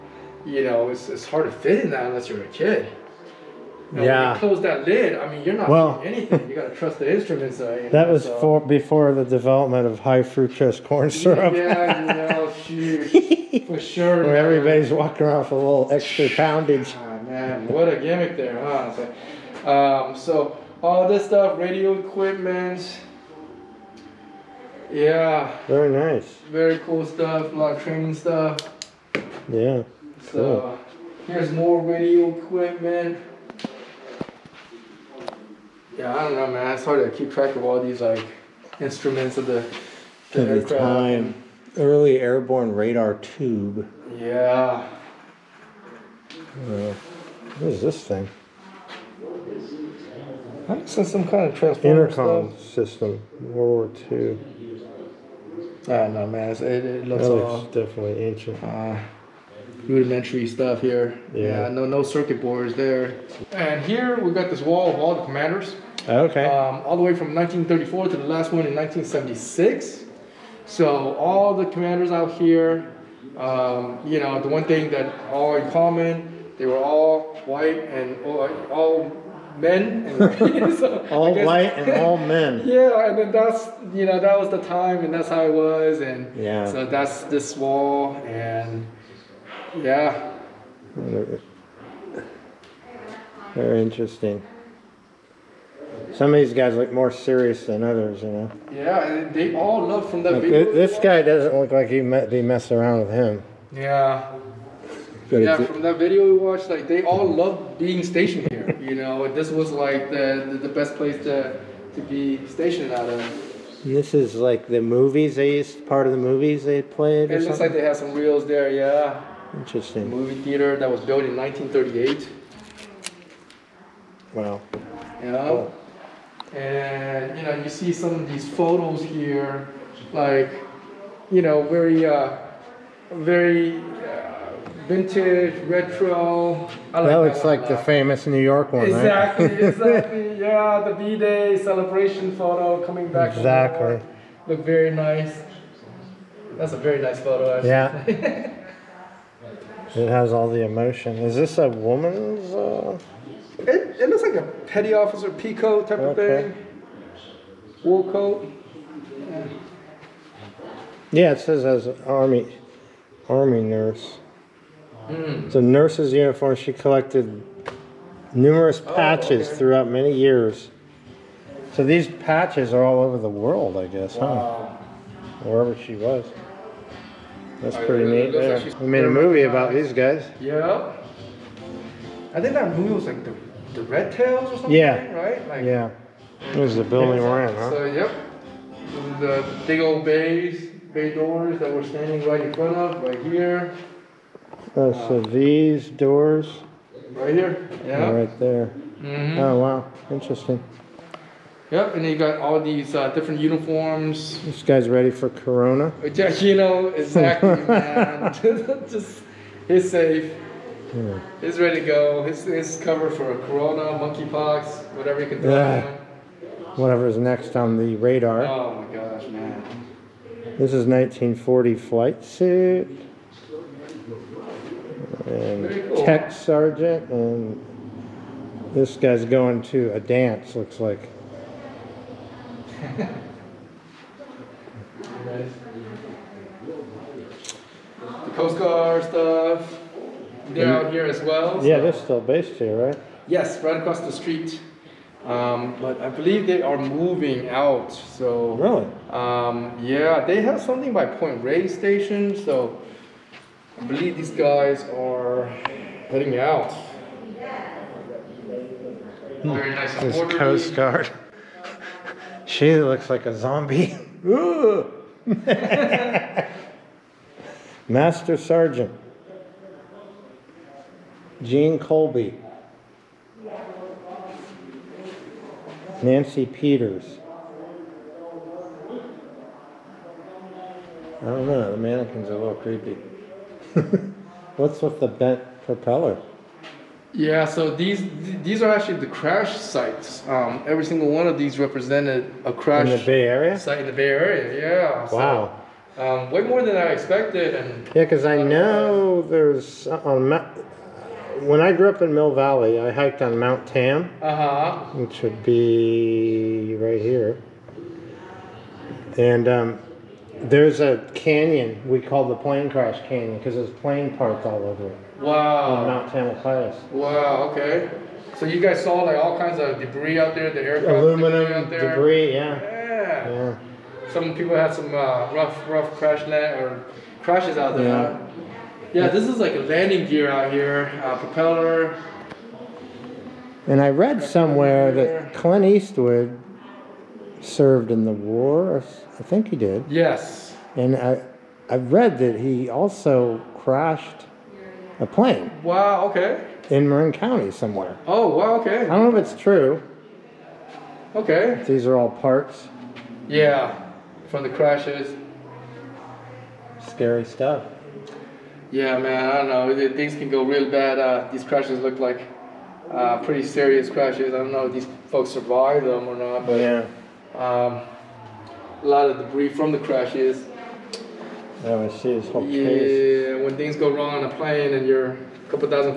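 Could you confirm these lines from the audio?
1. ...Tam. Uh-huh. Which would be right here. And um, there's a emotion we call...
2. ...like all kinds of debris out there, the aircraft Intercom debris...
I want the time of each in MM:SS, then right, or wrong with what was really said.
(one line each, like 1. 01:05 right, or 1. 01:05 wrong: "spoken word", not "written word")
1. 05:03 wrong: "canyon", not "emotion"
2. 05:19 wrong: "Aluminum", not "Intercom".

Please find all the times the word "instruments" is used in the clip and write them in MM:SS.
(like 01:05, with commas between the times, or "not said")
00:07, 00:38.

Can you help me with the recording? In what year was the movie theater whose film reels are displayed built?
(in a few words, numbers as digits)
1938.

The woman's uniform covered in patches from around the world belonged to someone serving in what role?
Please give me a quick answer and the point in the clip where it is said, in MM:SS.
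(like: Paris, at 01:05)
Army nurse, at 02:42.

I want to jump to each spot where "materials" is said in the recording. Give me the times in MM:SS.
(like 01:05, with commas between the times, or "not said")
not said.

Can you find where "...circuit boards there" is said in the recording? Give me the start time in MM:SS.
01:02.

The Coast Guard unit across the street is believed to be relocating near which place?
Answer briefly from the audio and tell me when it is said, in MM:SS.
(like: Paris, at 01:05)
Point Reyes Station, at 04:11.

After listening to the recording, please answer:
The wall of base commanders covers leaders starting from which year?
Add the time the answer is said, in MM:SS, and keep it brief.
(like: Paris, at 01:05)
1934, at 01:07.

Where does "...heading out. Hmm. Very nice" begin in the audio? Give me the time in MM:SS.
04:16.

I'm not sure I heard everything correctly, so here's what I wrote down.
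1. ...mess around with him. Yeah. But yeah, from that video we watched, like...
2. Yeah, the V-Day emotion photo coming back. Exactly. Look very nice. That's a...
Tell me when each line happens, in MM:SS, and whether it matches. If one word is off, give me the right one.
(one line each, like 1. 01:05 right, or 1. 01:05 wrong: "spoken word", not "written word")
1. 01:42 right
2. 02:20 wrong: "celebration", not "emotion".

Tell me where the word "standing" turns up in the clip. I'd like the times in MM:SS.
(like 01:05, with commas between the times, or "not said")
03:11.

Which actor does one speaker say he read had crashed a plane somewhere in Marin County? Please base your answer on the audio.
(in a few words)
Clint Eastwood.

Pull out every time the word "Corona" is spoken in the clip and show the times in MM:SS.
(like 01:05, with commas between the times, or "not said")
03:25, 03:33.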